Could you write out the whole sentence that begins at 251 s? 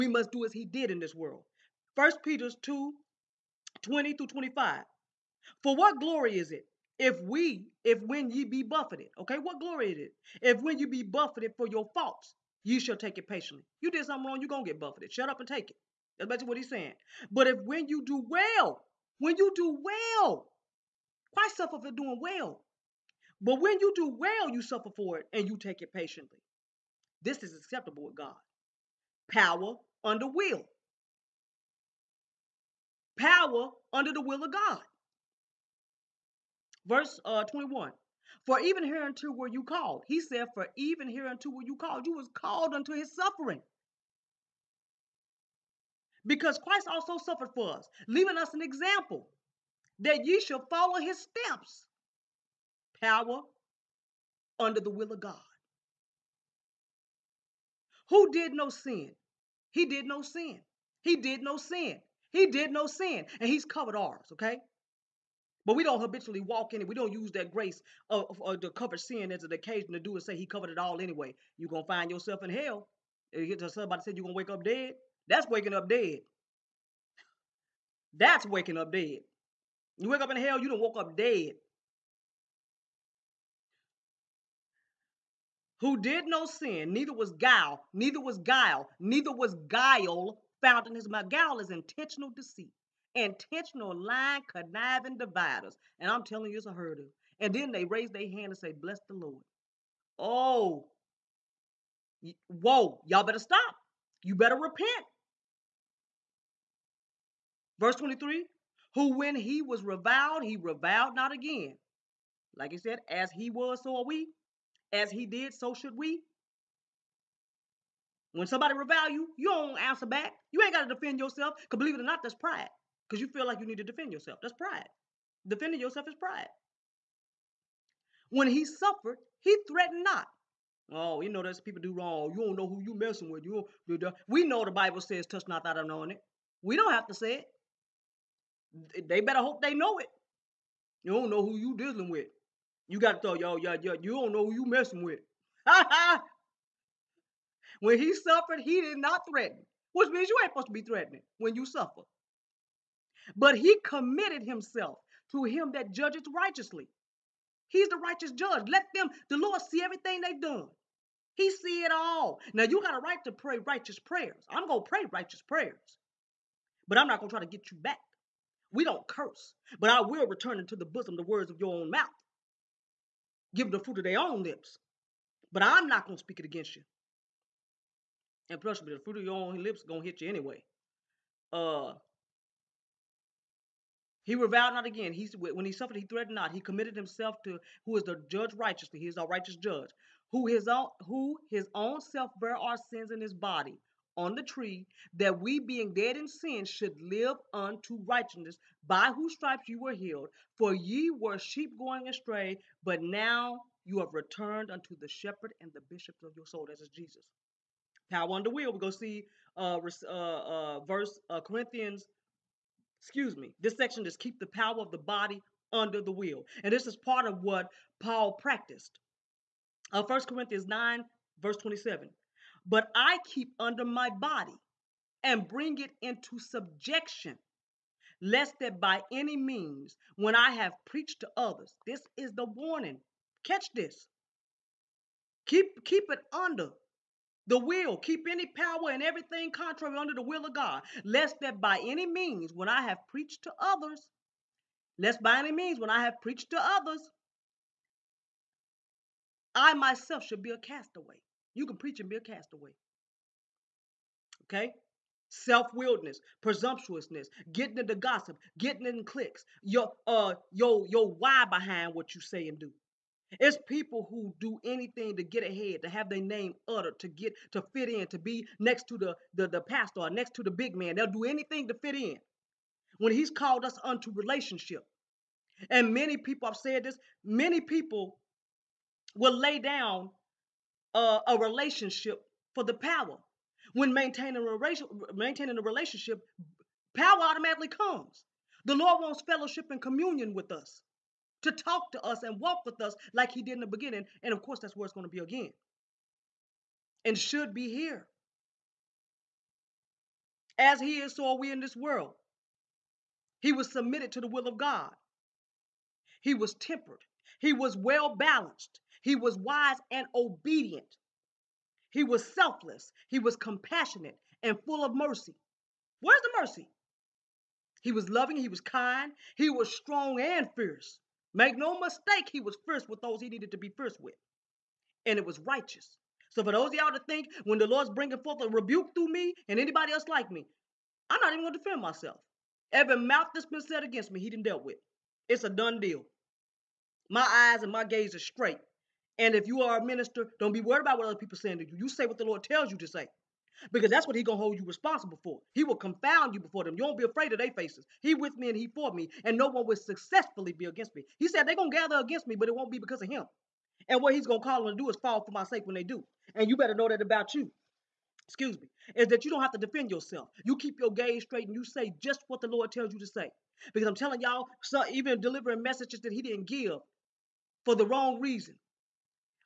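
You can preach and be a castaway.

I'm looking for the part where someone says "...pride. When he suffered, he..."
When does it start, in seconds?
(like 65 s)
126 s.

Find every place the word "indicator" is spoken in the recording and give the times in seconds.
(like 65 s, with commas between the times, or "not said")
not said.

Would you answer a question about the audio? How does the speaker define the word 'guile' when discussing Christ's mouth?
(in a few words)
intentional deceit.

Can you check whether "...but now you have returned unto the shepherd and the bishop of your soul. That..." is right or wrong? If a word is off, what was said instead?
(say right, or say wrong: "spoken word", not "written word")
right.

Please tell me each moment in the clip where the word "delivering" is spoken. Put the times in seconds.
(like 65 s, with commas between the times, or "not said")
365 s.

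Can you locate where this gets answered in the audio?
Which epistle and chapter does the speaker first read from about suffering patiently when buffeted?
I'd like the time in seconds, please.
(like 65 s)
1 s.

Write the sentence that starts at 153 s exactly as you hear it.
But he committed himself to him that judgeth righteously.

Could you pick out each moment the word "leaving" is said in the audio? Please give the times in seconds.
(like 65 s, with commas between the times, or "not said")
48 s.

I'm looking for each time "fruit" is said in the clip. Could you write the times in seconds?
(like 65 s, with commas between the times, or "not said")
173 s, 179 s.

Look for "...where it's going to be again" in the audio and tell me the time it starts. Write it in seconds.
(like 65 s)
294 s.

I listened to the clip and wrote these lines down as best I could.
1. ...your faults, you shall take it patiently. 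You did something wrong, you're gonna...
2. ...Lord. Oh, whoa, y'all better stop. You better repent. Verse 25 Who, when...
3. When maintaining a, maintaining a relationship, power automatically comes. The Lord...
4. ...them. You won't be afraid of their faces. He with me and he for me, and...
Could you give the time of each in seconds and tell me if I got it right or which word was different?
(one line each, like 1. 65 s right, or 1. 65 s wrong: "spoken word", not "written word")
1. 11 s right
2. 99 s wrong: "23", not "25"
3. 283 s right
4. 346 s right.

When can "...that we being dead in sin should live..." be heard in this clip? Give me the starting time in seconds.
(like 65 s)
195 s.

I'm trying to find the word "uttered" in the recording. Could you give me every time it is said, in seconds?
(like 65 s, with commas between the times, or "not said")
266 s.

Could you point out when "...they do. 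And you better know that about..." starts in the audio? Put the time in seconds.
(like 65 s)
355 s.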